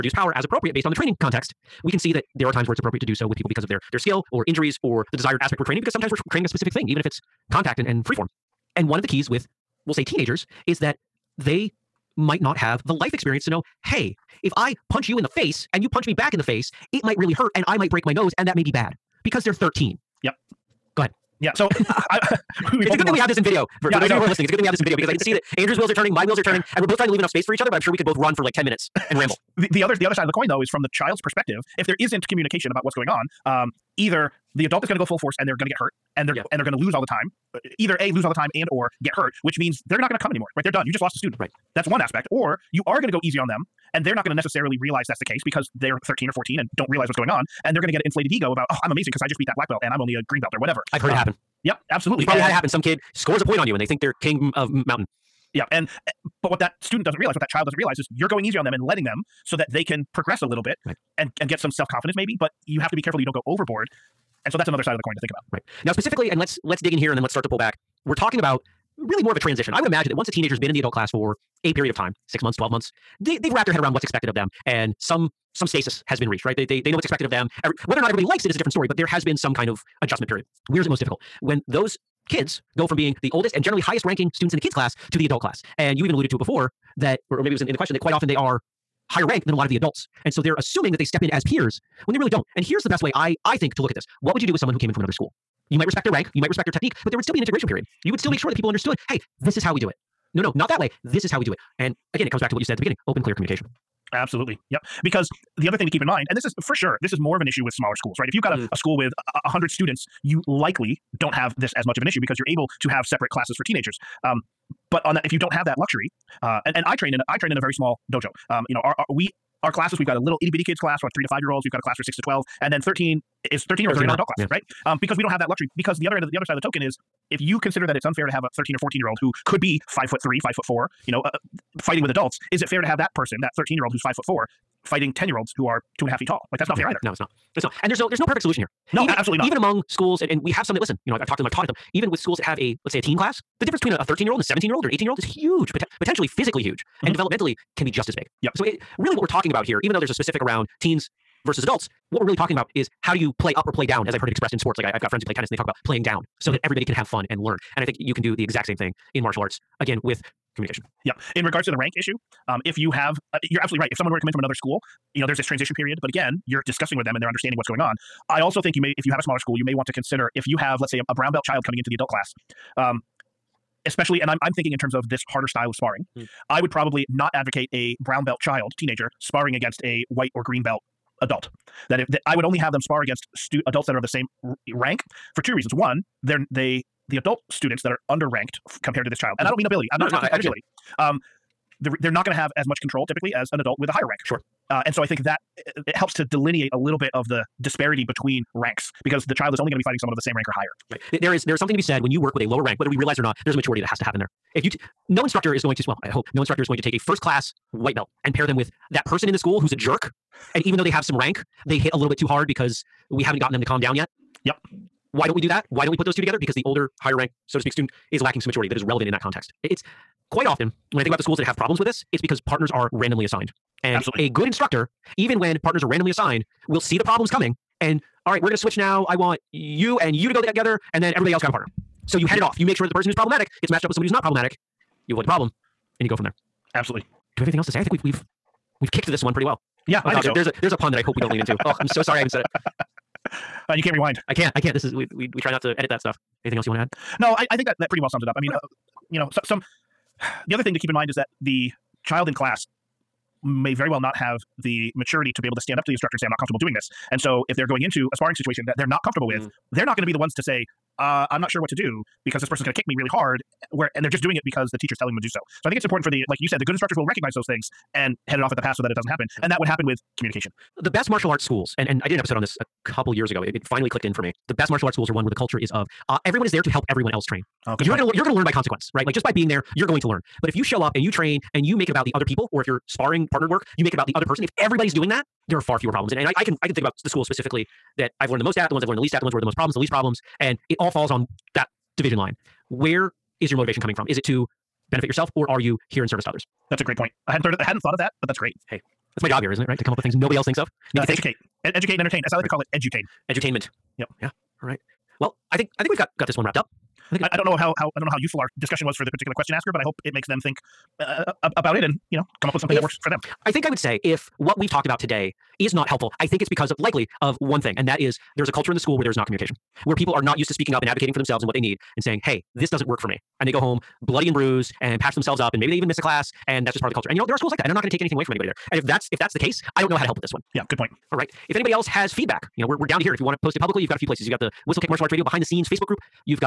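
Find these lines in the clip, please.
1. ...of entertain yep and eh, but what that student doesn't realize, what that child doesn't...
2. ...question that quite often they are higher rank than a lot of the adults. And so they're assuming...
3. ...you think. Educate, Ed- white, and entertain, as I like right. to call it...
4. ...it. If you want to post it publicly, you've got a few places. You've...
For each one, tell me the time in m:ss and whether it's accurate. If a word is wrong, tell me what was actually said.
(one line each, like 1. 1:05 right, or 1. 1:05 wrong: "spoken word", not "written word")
1. 0:54 wrong: "mountain", not "entertain"
2. 1:27 right
3. 5:01 wrong: "educate", not "white"
4. 5:33 right.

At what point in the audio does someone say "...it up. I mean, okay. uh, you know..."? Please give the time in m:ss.
4:08.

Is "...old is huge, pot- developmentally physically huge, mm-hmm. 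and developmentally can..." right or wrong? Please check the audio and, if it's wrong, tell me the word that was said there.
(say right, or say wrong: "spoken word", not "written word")
wrong: "potentially", not "developmentally".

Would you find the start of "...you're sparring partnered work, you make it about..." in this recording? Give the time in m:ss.
4:42.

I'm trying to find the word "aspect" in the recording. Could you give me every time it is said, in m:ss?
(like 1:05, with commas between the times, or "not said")
0:05, 0:41.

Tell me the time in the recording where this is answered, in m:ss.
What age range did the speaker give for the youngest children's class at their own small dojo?
2:01.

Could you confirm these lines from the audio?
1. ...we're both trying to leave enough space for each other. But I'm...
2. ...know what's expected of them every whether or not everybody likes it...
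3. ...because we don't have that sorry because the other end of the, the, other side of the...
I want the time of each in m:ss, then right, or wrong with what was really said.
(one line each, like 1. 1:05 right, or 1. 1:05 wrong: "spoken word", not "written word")
1. 0:26 right
2. 1:16 right
3. 2:05 wrong: "luxury", not "sorry".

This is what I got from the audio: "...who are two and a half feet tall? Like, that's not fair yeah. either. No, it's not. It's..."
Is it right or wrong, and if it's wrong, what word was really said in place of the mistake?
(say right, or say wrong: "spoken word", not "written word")
right.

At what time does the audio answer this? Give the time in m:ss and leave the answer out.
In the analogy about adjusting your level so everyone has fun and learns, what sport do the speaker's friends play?
2:35.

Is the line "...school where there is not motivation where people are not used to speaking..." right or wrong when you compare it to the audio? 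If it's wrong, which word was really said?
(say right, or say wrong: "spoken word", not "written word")
wrong: "communication", not "motivation".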